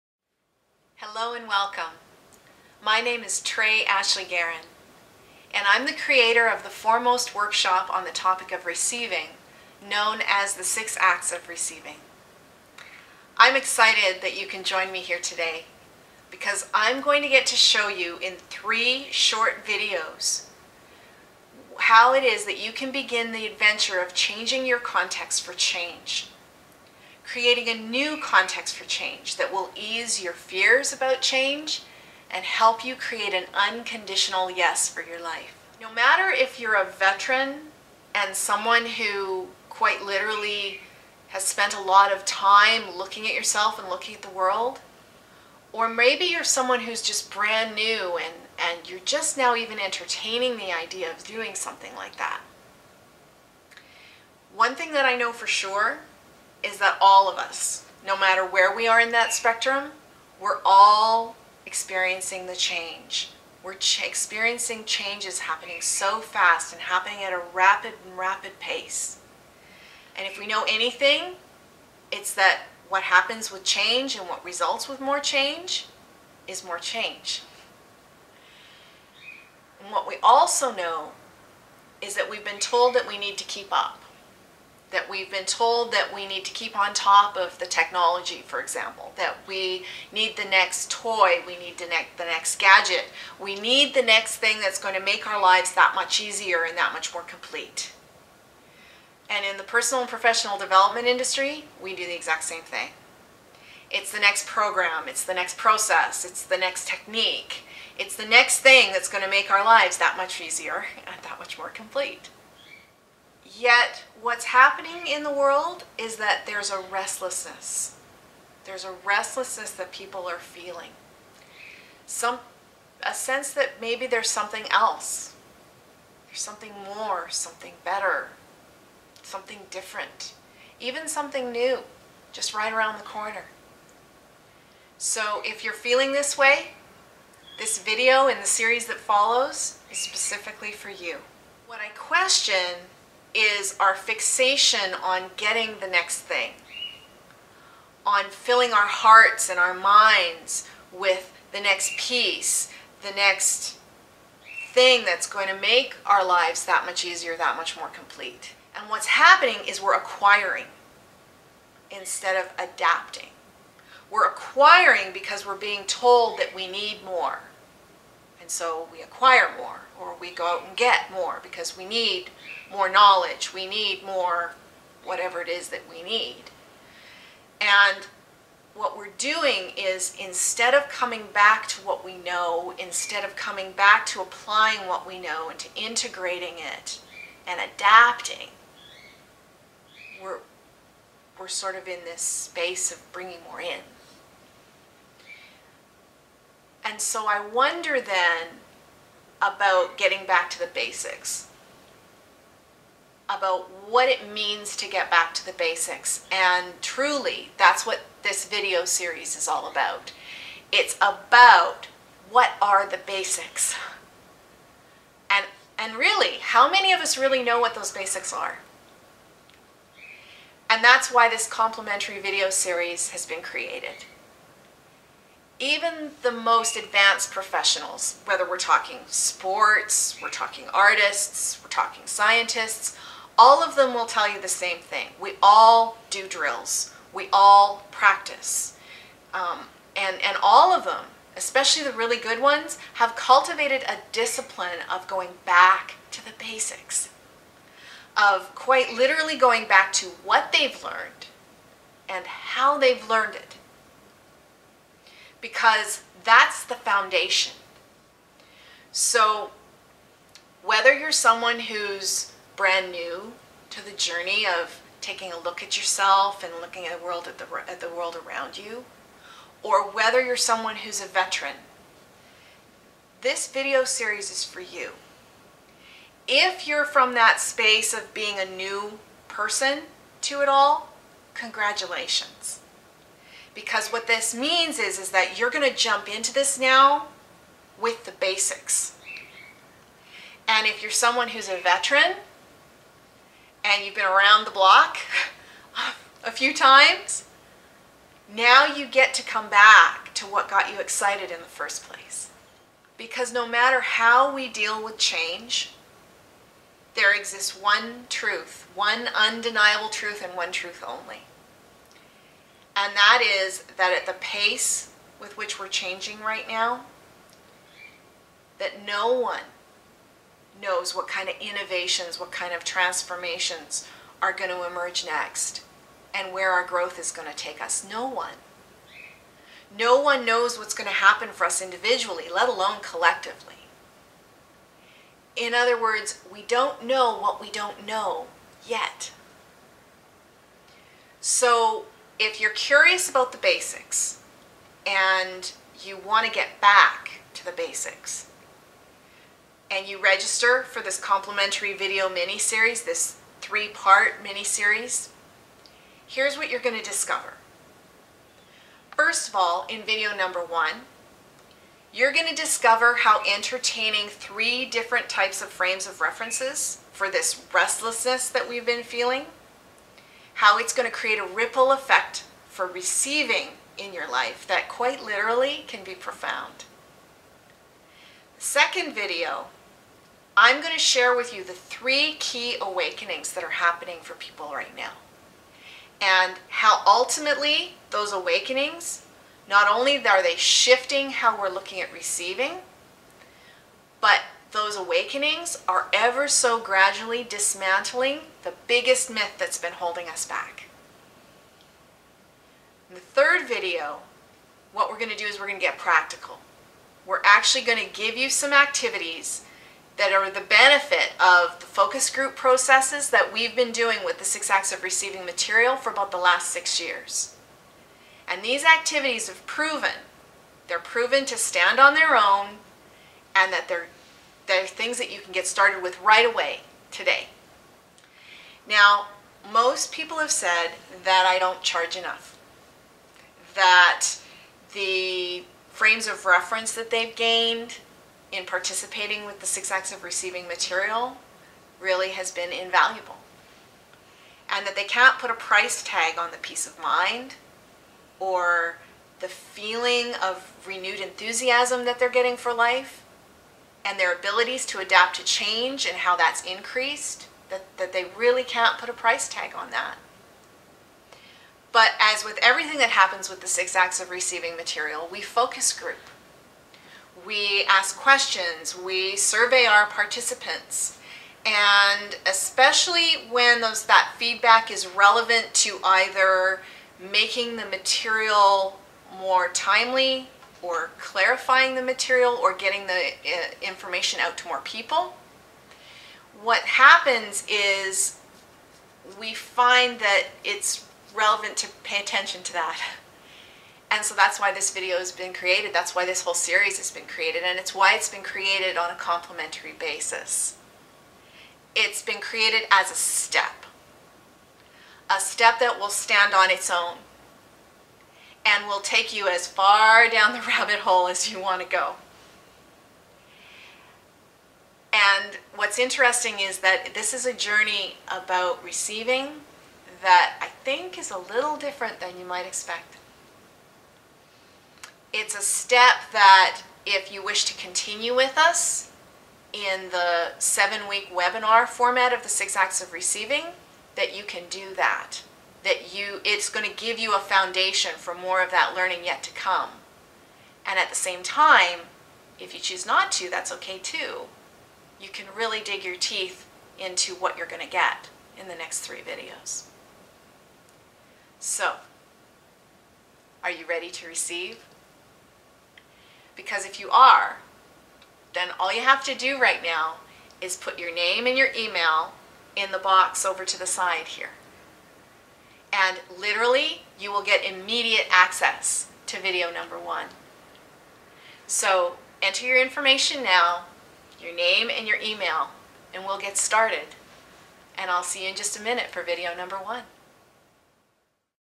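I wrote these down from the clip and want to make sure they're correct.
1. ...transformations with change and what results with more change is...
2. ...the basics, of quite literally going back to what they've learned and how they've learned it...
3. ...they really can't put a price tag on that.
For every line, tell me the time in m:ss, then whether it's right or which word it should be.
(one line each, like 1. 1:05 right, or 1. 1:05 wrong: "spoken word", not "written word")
1. 1:13 wrong: "happens", not "transformations"
2. 4:06 right
3. 7:37 right.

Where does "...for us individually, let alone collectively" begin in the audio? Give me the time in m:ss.
5:31.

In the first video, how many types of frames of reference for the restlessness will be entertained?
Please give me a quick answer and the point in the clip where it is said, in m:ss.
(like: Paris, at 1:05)
3, at 6:04.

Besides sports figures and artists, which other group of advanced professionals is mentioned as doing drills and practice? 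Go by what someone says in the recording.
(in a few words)
scientists.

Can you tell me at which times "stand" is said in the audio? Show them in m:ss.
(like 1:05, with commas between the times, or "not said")
7:01, 8:25.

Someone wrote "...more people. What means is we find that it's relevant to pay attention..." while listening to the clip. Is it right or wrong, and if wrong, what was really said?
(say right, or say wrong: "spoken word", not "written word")
wrong: "happens", not "means".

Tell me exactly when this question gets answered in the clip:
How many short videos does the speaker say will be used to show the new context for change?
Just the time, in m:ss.
0:18.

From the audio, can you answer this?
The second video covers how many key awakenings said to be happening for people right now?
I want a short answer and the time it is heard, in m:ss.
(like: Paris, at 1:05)
3, at 6:21.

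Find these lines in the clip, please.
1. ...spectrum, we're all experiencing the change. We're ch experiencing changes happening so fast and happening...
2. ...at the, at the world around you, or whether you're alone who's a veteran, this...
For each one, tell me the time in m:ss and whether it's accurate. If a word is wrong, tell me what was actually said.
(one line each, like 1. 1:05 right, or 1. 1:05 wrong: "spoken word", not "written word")
1. 0:59 right
2. 4:27 wrong: "someone", not "alone".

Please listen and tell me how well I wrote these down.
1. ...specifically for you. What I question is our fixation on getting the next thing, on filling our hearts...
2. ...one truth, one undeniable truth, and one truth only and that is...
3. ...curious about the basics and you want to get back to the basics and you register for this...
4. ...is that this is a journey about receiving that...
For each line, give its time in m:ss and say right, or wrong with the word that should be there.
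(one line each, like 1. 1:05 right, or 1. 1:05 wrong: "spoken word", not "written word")
1. 2:19 right
2. 5:07 right
3. 5:42 right
4. 8:36 right.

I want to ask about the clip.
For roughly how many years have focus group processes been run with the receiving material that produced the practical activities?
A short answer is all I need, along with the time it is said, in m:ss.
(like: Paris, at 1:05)
6, at 6:55.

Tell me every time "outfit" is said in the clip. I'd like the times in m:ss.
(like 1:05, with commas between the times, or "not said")
not said.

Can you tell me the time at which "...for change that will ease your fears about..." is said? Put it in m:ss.
0:28.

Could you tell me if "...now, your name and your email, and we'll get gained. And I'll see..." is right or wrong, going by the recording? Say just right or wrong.
wrong.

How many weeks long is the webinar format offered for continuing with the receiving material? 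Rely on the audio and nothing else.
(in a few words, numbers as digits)
7.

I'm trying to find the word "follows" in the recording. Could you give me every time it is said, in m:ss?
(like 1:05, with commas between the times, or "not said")
2:18.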